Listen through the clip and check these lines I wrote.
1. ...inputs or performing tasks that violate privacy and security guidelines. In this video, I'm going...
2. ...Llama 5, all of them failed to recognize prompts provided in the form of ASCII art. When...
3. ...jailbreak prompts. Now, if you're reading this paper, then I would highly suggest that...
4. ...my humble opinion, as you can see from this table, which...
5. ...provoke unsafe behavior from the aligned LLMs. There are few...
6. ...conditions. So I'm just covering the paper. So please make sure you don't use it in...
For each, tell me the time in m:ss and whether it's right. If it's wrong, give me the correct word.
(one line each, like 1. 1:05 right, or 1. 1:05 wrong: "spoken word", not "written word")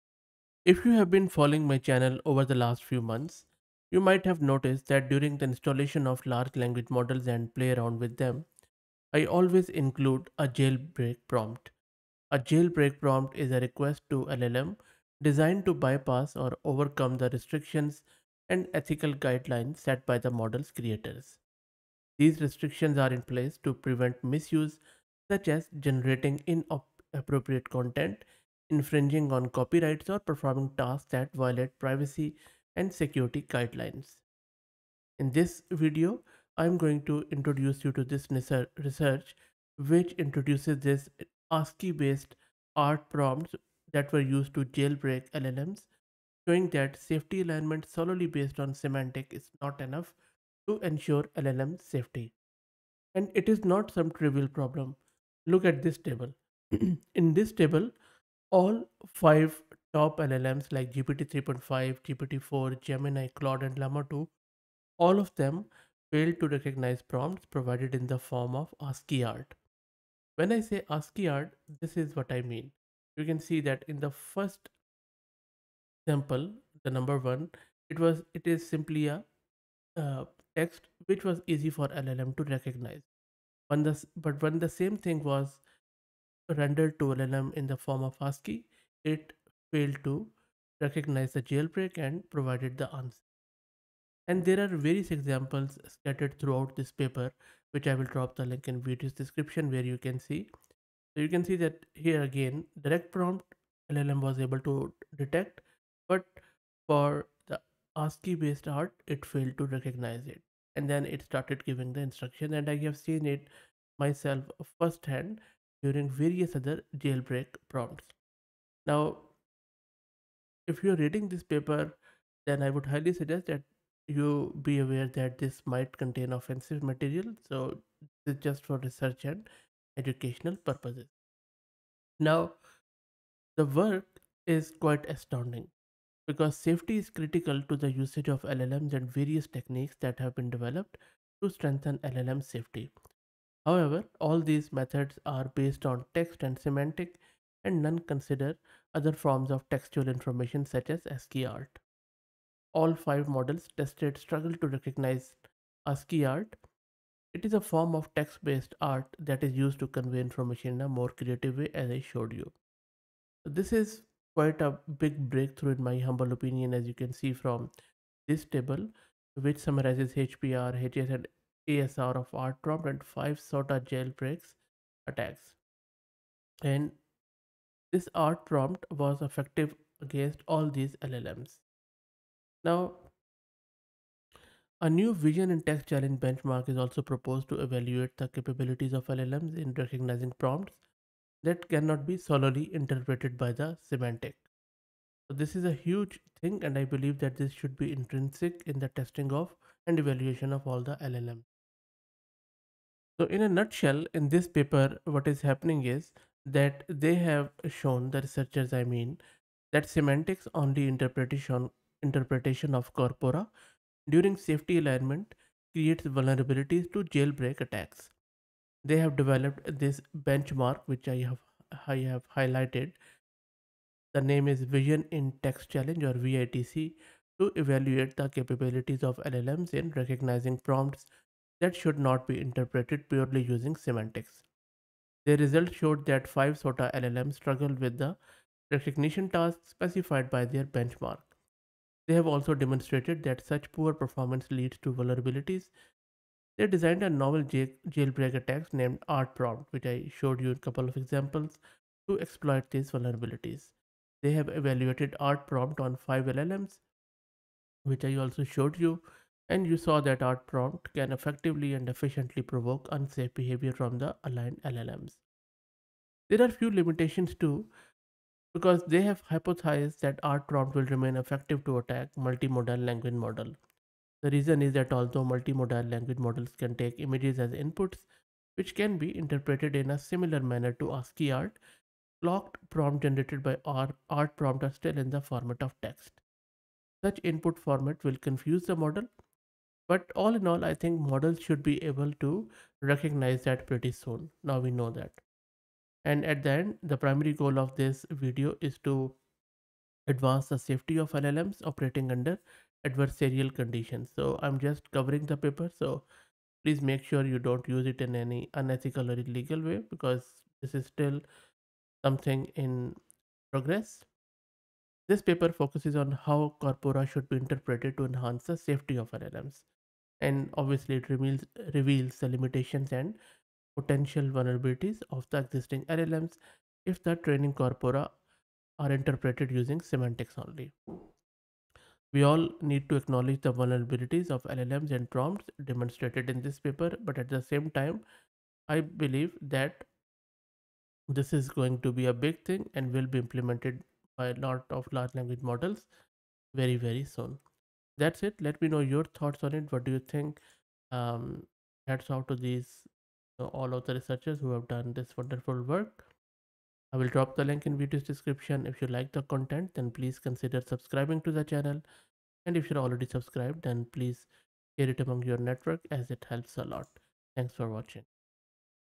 1. 0:29 wrong: "copyrights", not "inputs"
2. 1:03 wrong: "2", not "5"
3. 1:56 right
4. 2:45 right
5. 4:22 right
6. 5:03 right.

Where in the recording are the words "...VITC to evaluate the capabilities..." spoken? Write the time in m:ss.
3:46.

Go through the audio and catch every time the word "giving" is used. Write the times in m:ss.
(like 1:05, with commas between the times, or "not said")
1:51.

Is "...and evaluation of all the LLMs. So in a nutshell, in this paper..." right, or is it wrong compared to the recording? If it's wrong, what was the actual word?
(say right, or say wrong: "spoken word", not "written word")
right.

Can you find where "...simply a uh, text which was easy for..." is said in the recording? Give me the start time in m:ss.
1:18.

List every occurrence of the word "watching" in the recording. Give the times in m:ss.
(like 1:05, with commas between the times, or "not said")
6:07.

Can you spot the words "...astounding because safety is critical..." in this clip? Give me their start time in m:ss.
2:15.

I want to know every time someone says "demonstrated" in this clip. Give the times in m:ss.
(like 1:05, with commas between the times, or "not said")
4:02, 5:35.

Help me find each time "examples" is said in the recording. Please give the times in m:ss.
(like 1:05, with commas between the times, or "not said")
1:35, 4:10.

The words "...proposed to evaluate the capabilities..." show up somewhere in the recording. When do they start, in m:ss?
3:07.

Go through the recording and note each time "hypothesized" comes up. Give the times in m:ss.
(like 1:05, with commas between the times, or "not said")
4:29.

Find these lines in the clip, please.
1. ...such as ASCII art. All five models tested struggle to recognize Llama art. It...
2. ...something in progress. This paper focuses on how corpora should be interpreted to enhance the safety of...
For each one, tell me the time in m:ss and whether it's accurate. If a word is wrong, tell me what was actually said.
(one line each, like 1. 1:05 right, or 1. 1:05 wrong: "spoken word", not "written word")
1. 2:30 wrong: "ASCII", not "Llama"
2. 5:12 right.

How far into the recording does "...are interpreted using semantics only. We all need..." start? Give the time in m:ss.
5:28.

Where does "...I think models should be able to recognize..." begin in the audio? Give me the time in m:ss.
4:50.